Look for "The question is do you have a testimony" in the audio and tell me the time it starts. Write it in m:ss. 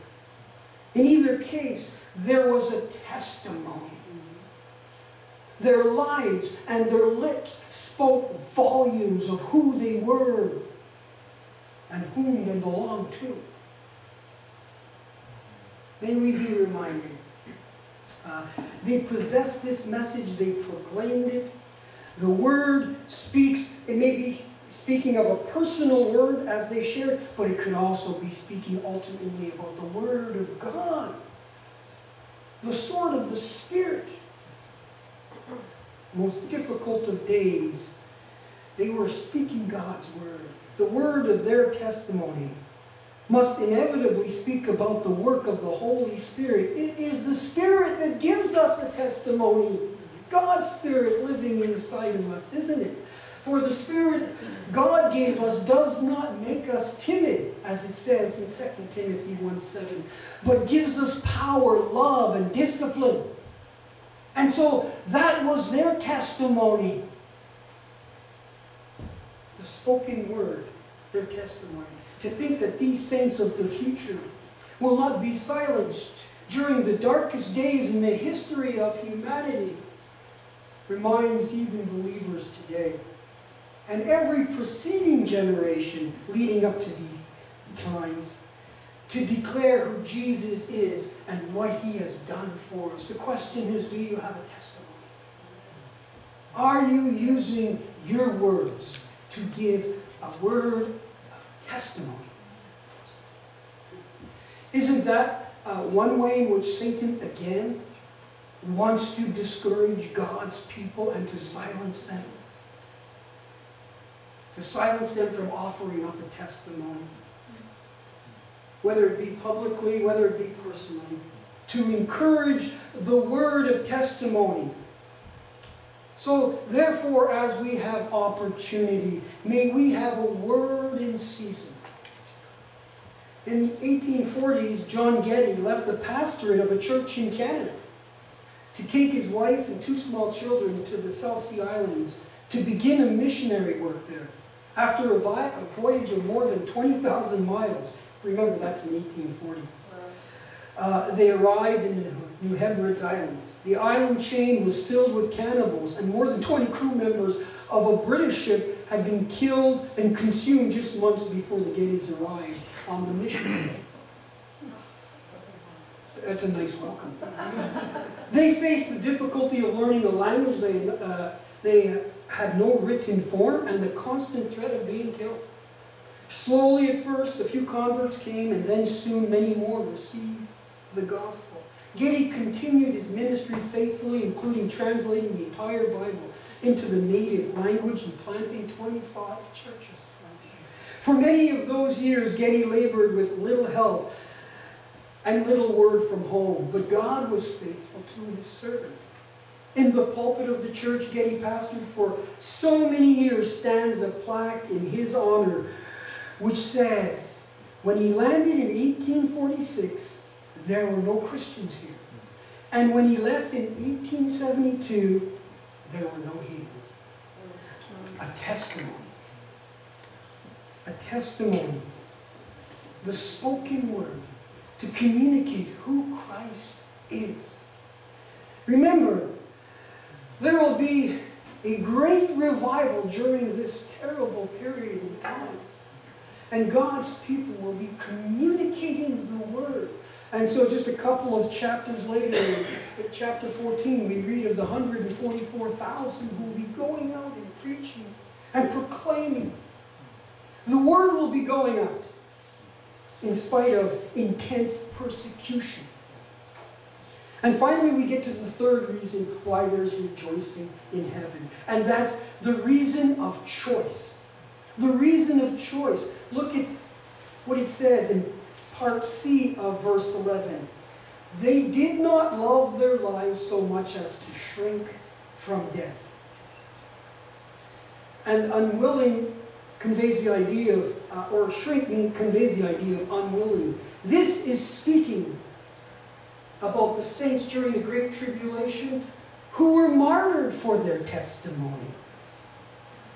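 1:33.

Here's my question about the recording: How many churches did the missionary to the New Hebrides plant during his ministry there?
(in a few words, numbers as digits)
25.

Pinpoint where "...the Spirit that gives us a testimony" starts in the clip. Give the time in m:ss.
0:47.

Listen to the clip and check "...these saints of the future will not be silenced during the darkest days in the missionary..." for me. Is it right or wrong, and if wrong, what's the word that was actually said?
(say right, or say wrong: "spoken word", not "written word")
wrong: "history", not "missionary".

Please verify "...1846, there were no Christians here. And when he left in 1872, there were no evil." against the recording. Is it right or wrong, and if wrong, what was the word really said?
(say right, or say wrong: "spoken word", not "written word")
right.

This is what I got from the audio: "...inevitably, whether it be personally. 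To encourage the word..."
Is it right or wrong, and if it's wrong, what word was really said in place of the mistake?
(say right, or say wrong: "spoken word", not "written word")
wrong: "publicly", not "inevitably".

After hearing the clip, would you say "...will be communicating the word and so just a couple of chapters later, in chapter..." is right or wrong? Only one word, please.
right.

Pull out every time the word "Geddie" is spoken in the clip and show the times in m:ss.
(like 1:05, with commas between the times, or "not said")
2:15, 2:41, 3:01, 3:12, 3:21.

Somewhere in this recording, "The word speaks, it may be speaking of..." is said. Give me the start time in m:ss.
0:22.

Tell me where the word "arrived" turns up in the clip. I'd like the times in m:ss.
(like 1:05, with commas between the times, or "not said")
2:31, 2:42.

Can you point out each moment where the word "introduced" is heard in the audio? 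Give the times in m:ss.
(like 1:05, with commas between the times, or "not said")
not said.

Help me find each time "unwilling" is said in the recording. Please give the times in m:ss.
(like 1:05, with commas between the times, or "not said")
4:38, 4:43.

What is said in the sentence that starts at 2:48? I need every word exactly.
they faced the difficulty of learning the language they, uh, they had no written form and the constant threat of being killed.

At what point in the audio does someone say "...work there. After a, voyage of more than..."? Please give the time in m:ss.
2:23.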